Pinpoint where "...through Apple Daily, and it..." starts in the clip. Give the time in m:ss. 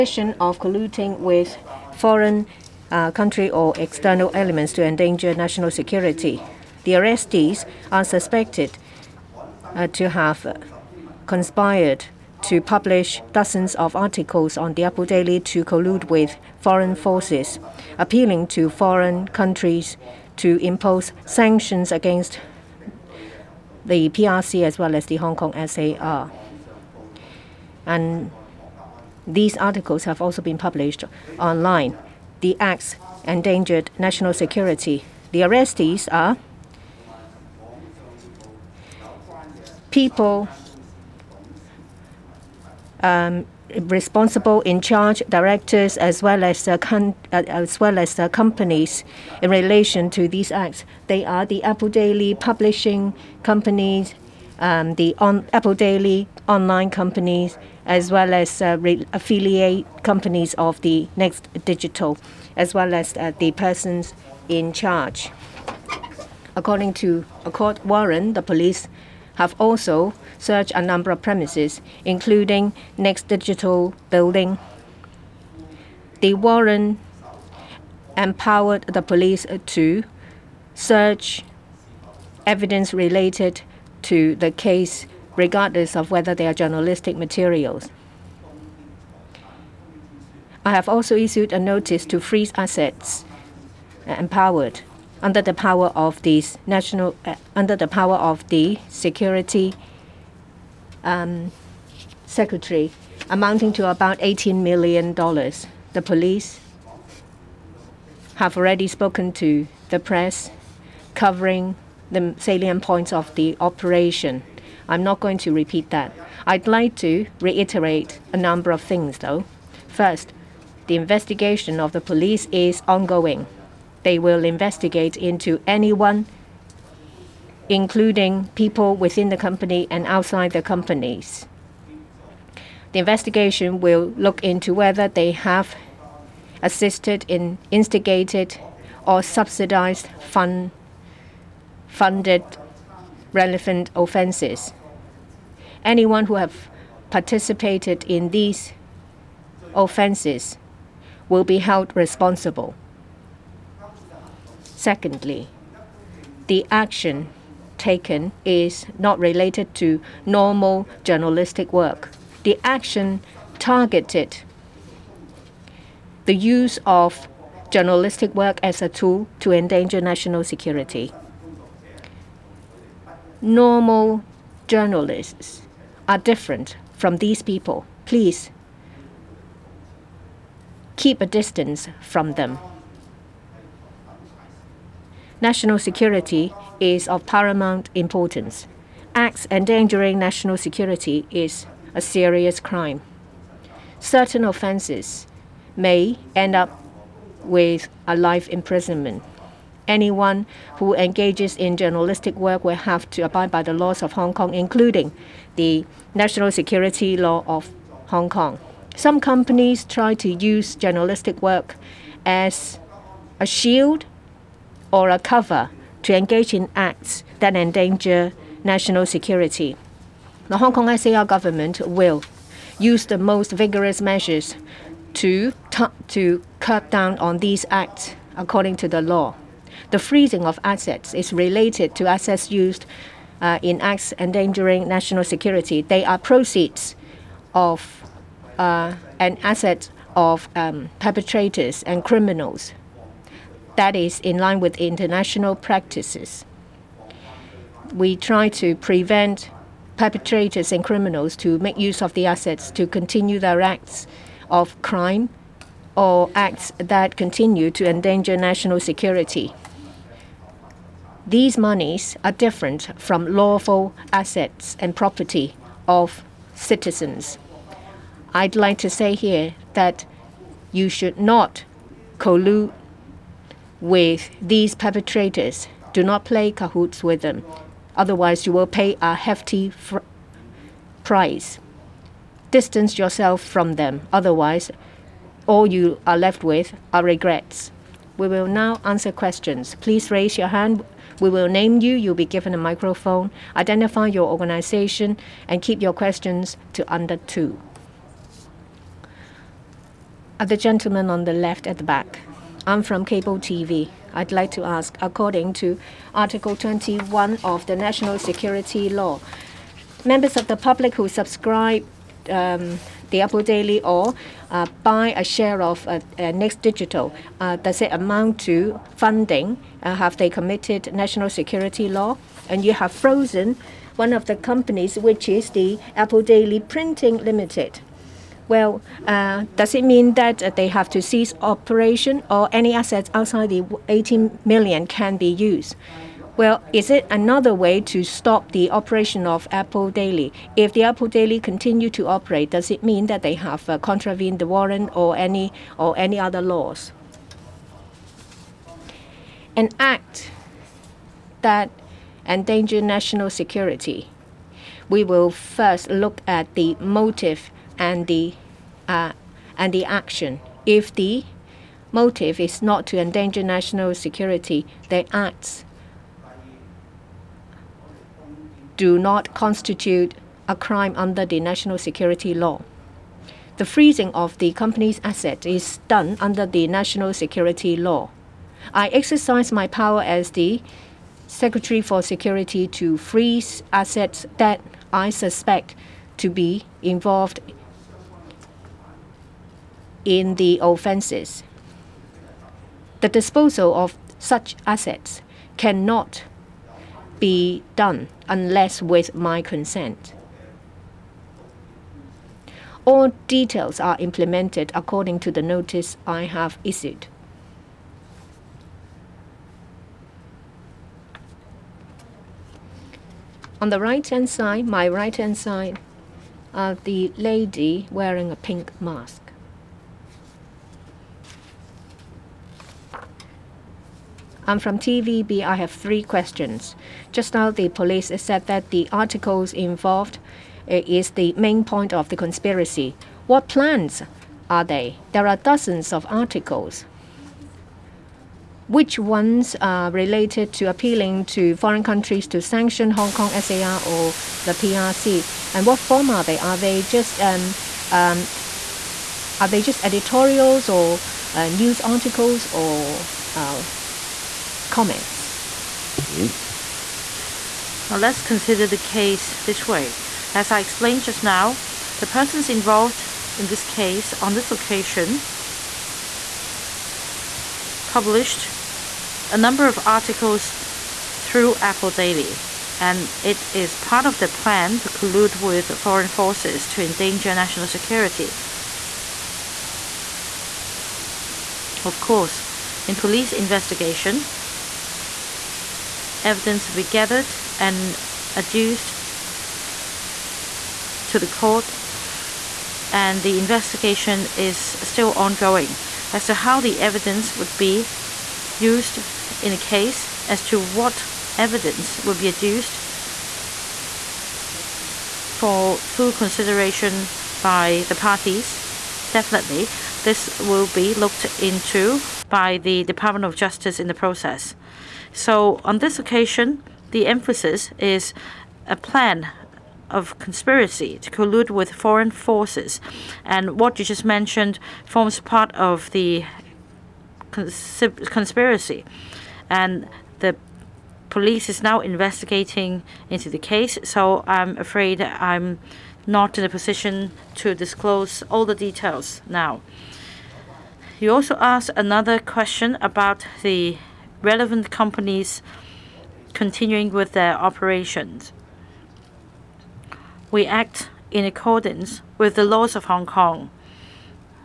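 7:51.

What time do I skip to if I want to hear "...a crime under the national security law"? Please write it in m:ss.
6:10.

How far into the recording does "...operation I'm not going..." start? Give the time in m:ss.
1:53.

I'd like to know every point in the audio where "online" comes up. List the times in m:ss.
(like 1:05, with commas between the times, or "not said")
0:31, 0:56.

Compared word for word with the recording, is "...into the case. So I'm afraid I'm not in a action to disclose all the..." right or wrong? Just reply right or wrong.
wrong.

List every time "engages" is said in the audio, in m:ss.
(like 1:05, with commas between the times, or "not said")
3:20, 3:36.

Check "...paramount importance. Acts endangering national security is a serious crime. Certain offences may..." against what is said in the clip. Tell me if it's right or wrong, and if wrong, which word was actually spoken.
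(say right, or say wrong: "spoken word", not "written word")
right.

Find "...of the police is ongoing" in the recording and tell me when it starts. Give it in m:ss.
2:01.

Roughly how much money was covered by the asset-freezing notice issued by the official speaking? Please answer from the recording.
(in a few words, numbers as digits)
18 million dollars.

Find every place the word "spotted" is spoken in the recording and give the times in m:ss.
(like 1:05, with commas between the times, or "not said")
not said.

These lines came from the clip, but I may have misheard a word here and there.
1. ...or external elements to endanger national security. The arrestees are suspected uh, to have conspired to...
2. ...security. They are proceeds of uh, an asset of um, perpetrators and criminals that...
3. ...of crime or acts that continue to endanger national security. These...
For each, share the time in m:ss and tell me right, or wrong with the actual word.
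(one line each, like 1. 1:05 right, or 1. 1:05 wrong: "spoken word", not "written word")
1. 0:03 right
2. 3:55 right
3. 4:14 right.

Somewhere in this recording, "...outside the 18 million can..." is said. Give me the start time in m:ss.
5:33.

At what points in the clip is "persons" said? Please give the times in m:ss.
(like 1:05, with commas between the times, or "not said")
1:03, 7:42.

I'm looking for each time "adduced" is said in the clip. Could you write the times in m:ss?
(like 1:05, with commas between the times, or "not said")
8:08, 8:22.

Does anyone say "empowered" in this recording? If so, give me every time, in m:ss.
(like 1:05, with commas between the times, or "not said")
1:18, 1:34.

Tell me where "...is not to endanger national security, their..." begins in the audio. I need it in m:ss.
6:02.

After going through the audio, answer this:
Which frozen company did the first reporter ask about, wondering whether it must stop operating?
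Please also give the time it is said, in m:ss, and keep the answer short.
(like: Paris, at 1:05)
Apple Daily Printing Limited, at 5:25.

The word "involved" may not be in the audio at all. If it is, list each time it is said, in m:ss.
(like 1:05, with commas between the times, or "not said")
6:26, 7:09, 7:42.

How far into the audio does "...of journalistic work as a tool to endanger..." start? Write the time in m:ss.
2:46.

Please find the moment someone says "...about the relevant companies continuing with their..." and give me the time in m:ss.
9:02.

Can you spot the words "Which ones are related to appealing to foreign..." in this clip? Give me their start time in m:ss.
7:18.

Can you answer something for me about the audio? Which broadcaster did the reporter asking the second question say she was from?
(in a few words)
TVB.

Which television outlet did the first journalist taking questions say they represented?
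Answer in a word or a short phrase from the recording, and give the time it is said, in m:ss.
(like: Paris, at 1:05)
Cable TV, at 5:03.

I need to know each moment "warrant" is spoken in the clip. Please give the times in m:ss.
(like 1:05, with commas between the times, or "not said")
1:07, 1:16, 5:44.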